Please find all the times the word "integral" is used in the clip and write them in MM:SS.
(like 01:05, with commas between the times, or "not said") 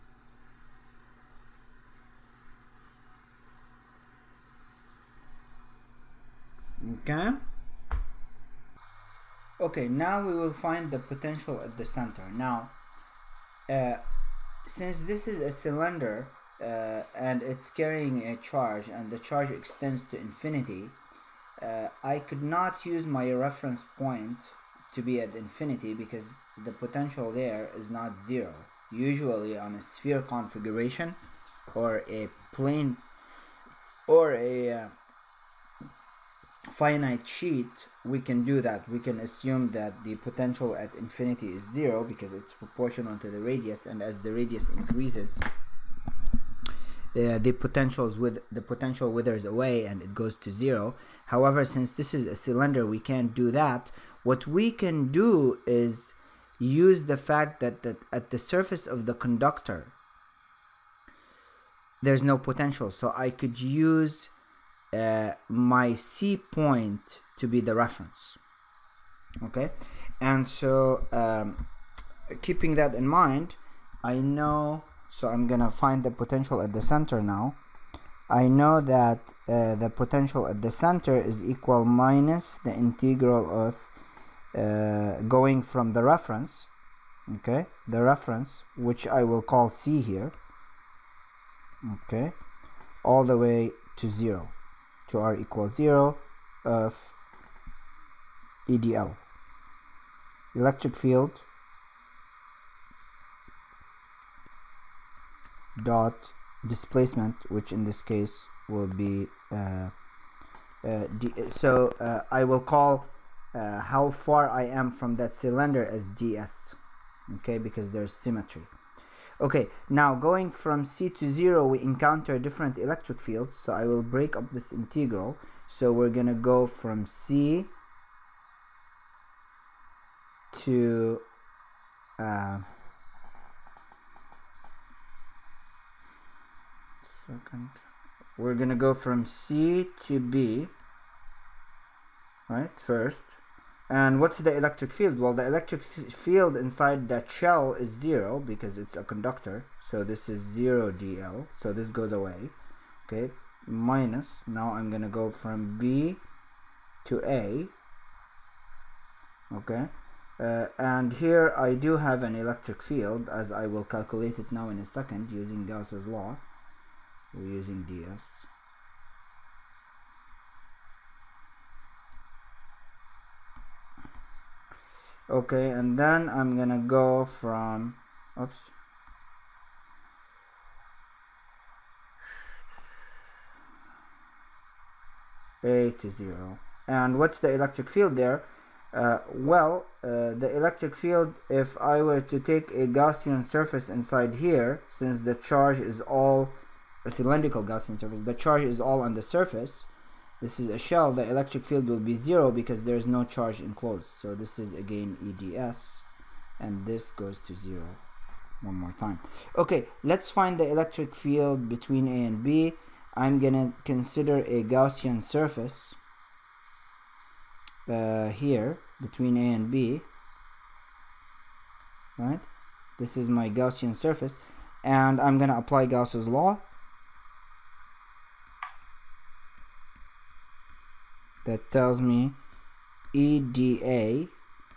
01:22, 02:04.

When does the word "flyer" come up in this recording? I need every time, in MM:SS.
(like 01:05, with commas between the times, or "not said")
not said.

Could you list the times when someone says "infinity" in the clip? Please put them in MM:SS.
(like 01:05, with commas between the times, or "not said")
00:20, 00:25, 00:40.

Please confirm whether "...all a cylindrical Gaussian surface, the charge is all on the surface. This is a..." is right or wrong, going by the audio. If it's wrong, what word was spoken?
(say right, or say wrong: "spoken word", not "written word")
right.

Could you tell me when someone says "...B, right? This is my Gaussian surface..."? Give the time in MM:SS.
03:39.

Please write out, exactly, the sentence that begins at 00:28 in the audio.
Usually on a sphere configuration or a plane or a uh, finite sheet, we can do that.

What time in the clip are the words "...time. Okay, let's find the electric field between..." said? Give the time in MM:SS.
03:28.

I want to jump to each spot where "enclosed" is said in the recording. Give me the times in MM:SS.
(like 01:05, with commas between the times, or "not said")
03:23.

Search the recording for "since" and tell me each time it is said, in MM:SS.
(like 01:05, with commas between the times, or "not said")
00:14, 00:51, 03:14.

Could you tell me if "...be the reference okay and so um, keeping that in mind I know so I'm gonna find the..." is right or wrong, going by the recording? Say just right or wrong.
right.